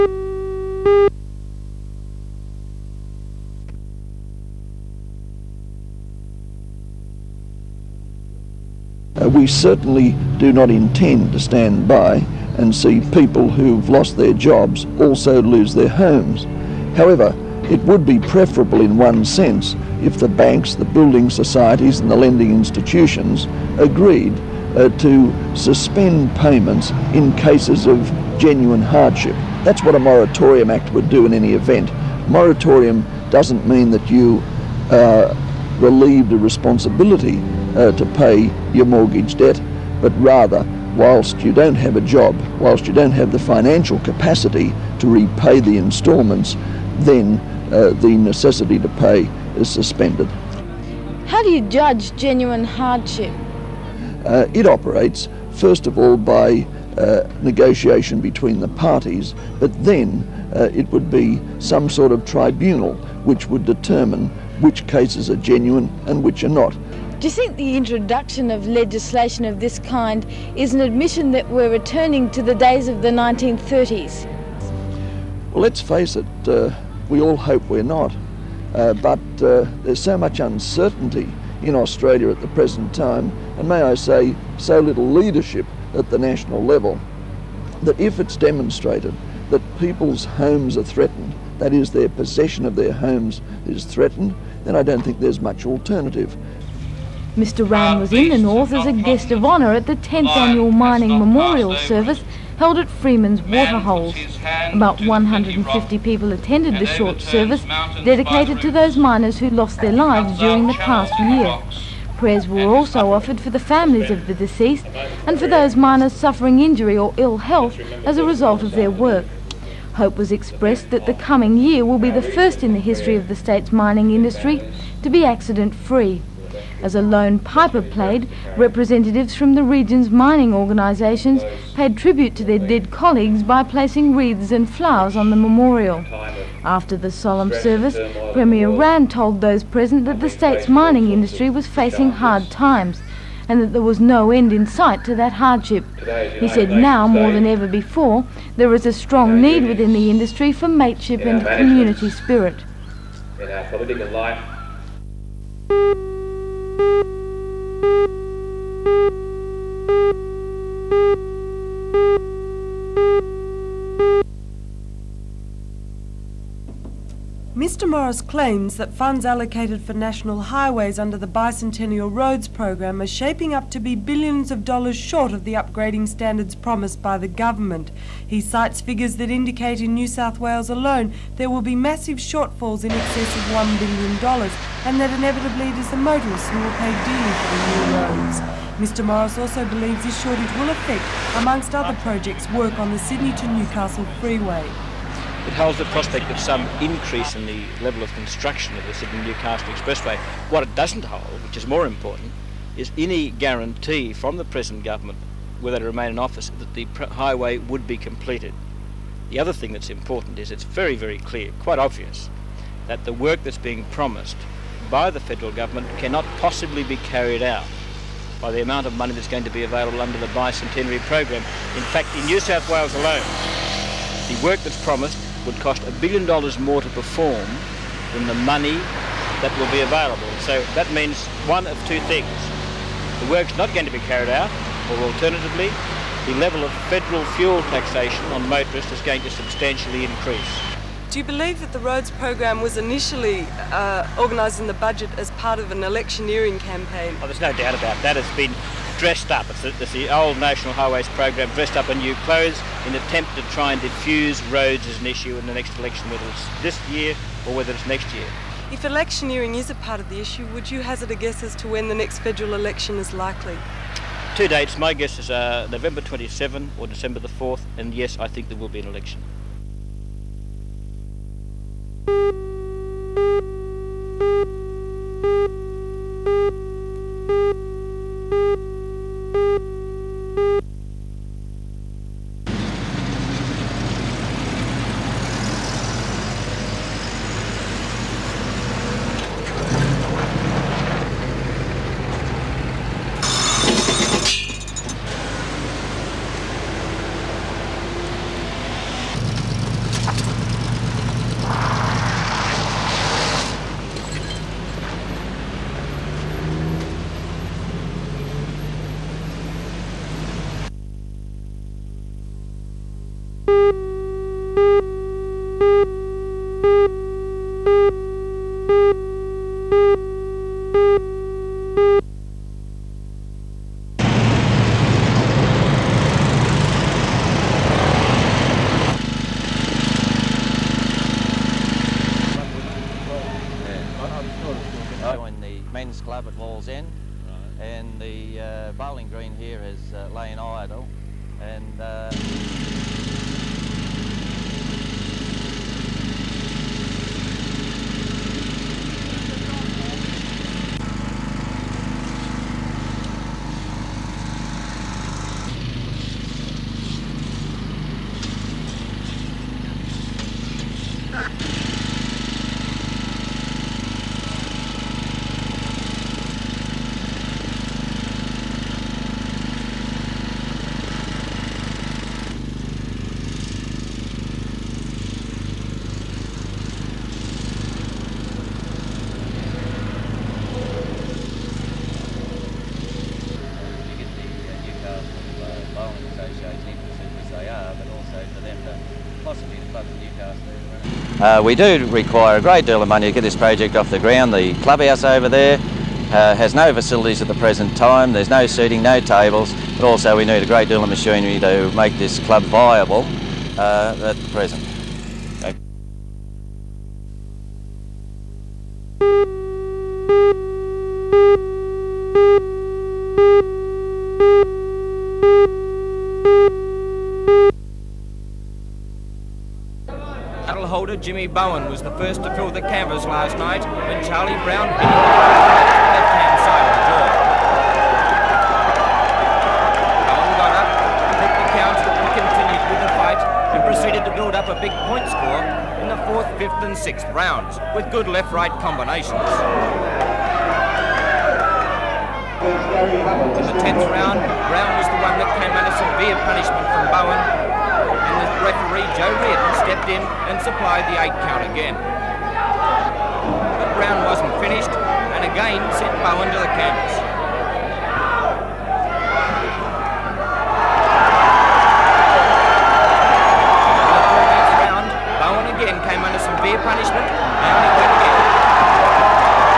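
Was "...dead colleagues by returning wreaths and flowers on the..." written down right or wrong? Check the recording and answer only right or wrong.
wrong.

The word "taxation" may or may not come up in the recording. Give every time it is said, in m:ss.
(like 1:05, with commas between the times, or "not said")
3:57.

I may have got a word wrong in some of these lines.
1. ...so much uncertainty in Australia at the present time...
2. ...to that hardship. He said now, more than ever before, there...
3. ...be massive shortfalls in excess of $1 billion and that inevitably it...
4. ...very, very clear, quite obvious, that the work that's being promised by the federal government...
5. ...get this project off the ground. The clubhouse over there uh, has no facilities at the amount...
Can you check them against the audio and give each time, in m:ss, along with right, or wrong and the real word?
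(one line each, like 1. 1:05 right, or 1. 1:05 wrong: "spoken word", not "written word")
1. 1:20 right
2. 2:25 right
3. 3:01 right
4. 3:30 right
5. 6:33 wrong: "present", not "amount".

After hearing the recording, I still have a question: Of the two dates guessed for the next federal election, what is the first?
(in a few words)
November 27.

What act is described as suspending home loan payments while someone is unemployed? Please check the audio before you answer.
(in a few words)
Moratorium act.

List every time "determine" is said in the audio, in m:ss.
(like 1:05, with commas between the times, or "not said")
1:03.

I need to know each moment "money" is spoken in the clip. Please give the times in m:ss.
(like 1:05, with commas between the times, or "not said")
3:38, 3:48, 6:32.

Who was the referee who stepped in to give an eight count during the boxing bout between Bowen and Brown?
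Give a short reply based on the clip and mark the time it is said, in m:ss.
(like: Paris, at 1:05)
Joe Reardon, at 7:28.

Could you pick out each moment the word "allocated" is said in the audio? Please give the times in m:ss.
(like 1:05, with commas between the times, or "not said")
2:49.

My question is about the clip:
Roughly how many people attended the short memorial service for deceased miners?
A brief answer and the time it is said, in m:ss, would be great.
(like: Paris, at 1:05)
150, at 1:45.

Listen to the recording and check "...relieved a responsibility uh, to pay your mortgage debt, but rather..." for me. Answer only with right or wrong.
right.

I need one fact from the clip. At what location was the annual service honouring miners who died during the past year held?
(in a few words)
Freeman's Waterholes.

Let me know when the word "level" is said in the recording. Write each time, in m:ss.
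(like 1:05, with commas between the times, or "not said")
1:26, 3:17, 3:56.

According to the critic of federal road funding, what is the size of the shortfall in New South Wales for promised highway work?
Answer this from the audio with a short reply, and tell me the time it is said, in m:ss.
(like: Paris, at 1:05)
$1 billion, at 3:45.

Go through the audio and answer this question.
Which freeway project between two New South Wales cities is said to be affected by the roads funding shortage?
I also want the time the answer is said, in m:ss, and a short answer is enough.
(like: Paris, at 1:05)
Sydney to Newcastle freeway, at 3:12.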